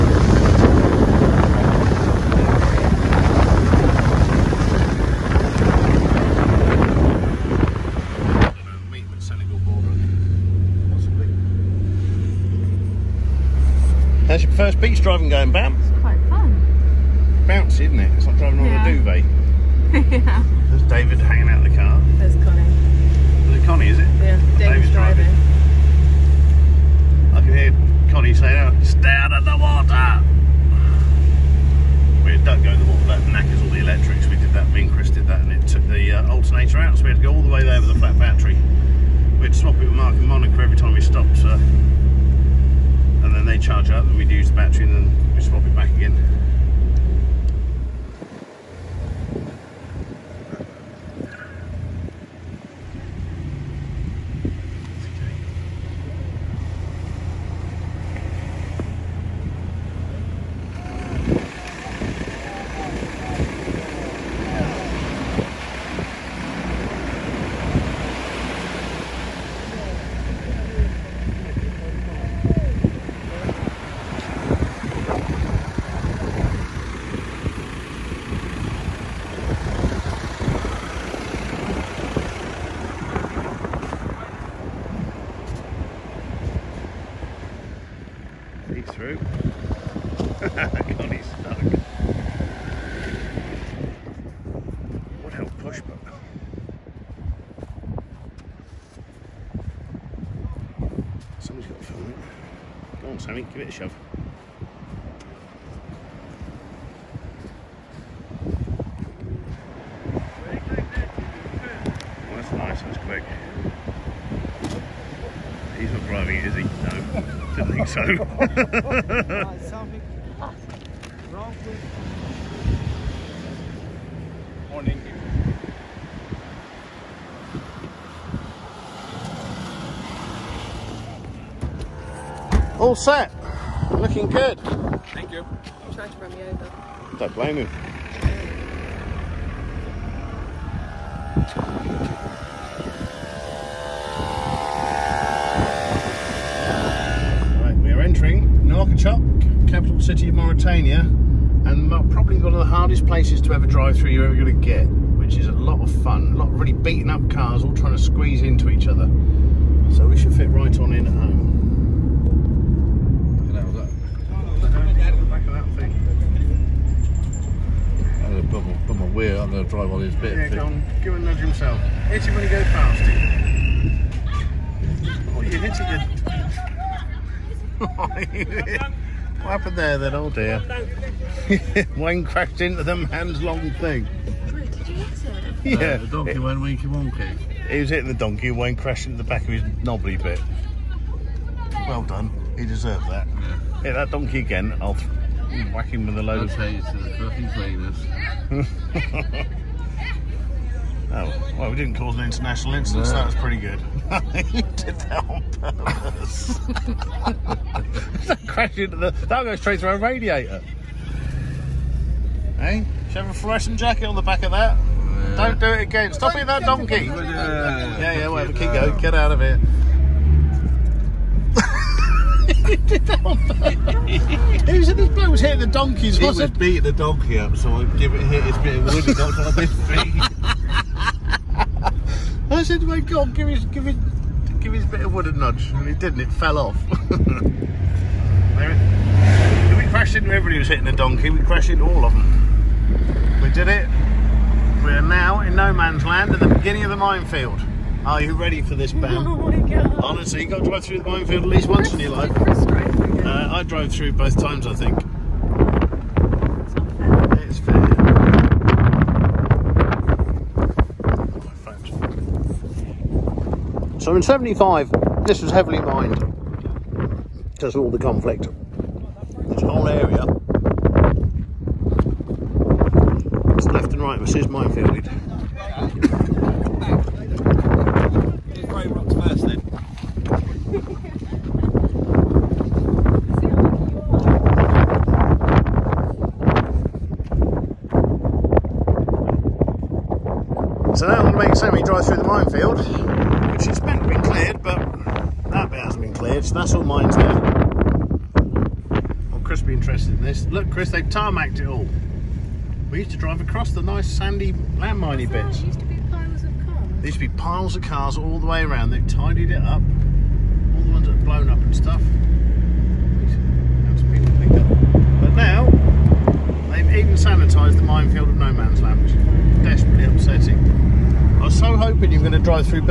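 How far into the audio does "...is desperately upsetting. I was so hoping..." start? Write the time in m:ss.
5:19.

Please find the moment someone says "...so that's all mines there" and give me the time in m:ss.
4:56.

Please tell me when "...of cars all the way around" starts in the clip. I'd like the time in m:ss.
5:07.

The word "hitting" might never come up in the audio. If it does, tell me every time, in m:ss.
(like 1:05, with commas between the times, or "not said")
3:07, 3:45, 4:00.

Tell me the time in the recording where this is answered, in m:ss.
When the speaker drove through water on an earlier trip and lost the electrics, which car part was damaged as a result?
0:36.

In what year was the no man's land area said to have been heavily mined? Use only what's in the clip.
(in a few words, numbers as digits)
1975.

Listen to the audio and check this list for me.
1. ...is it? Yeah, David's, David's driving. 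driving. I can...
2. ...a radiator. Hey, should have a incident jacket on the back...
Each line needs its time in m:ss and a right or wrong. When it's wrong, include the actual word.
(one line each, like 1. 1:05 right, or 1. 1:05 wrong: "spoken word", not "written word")
1. 0:23 right
2. 3:29 wrong: "fluorescent", not "incident".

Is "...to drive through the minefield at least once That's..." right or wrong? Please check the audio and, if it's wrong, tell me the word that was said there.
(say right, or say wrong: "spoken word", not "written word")
right.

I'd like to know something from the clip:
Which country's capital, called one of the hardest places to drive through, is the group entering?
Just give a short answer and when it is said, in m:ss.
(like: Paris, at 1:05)
Mauritania, at 2:30.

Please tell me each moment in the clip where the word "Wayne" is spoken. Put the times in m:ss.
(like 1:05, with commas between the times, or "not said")
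3:01, 3:08.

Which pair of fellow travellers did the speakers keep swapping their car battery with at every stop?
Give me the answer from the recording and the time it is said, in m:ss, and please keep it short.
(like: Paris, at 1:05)
Mark and Monica, at 0:39.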